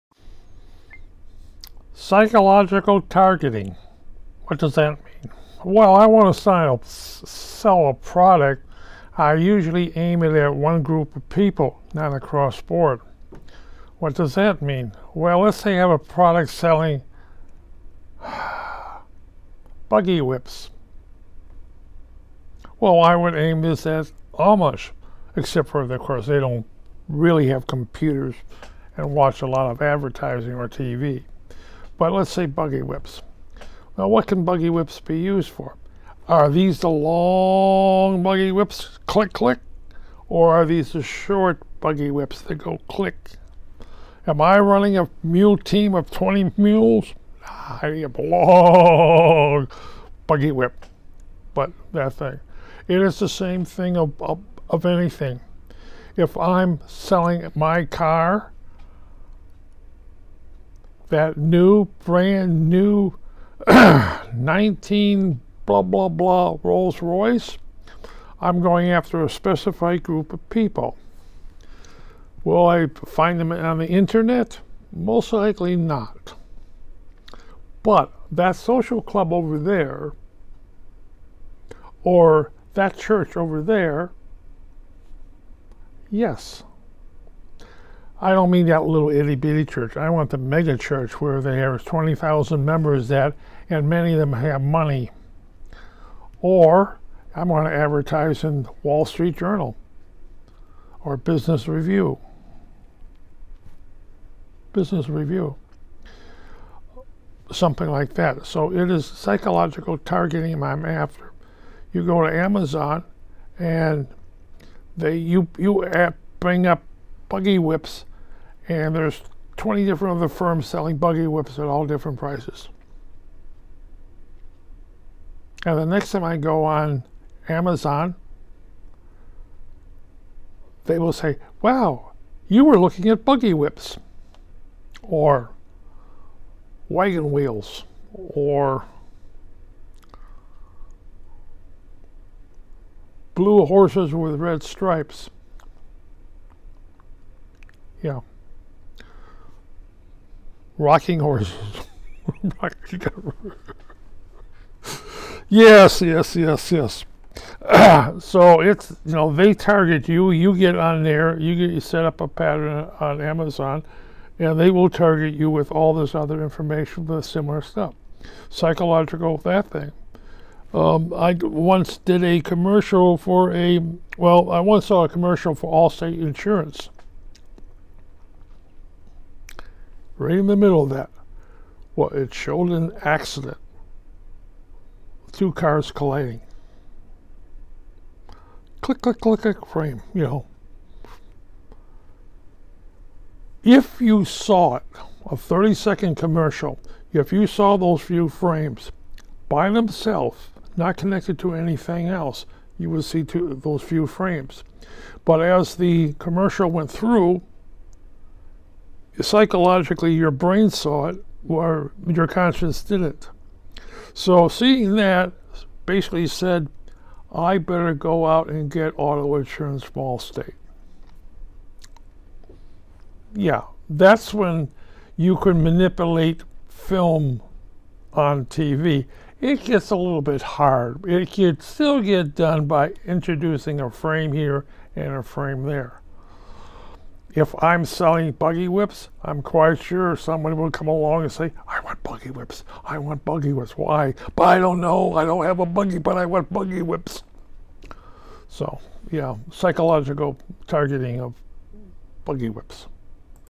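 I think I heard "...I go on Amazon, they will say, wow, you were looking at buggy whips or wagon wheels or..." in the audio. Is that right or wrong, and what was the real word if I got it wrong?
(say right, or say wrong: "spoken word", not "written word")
right.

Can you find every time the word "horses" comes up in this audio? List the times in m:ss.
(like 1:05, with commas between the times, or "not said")
2:23, 2:31.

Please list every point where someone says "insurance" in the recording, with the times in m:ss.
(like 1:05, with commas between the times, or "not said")
2:56, 3:39.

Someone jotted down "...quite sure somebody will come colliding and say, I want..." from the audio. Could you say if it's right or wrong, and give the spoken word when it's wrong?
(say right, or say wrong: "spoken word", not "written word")
wrong: "along", not "colliding".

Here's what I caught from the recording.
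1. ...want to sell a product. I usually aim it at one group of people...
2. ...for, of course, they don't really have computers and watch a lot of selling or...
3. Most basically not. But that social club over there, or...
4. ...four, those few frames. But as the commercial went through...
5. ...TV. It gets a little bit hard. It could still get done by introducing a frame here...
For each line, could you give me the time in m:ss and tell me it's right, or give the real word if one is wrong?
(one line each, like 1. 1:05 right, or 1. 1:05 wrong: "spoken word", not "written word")
1. 0:06 right
2. 0:25 wrong: "advertising", not "selling"
3. 1:14 wrong: "likely", not "basically"
4. 3:23 wrong: "two", not "four"
5. 3:48 right.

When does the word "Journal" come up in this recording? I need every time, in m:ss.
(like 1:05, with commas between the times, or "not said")
1:39.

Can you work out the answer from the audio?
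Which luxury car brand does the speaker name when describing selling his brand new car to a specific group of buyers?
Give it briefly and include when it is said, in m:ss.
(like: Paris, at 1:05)
Rolls Royce, at 1:06.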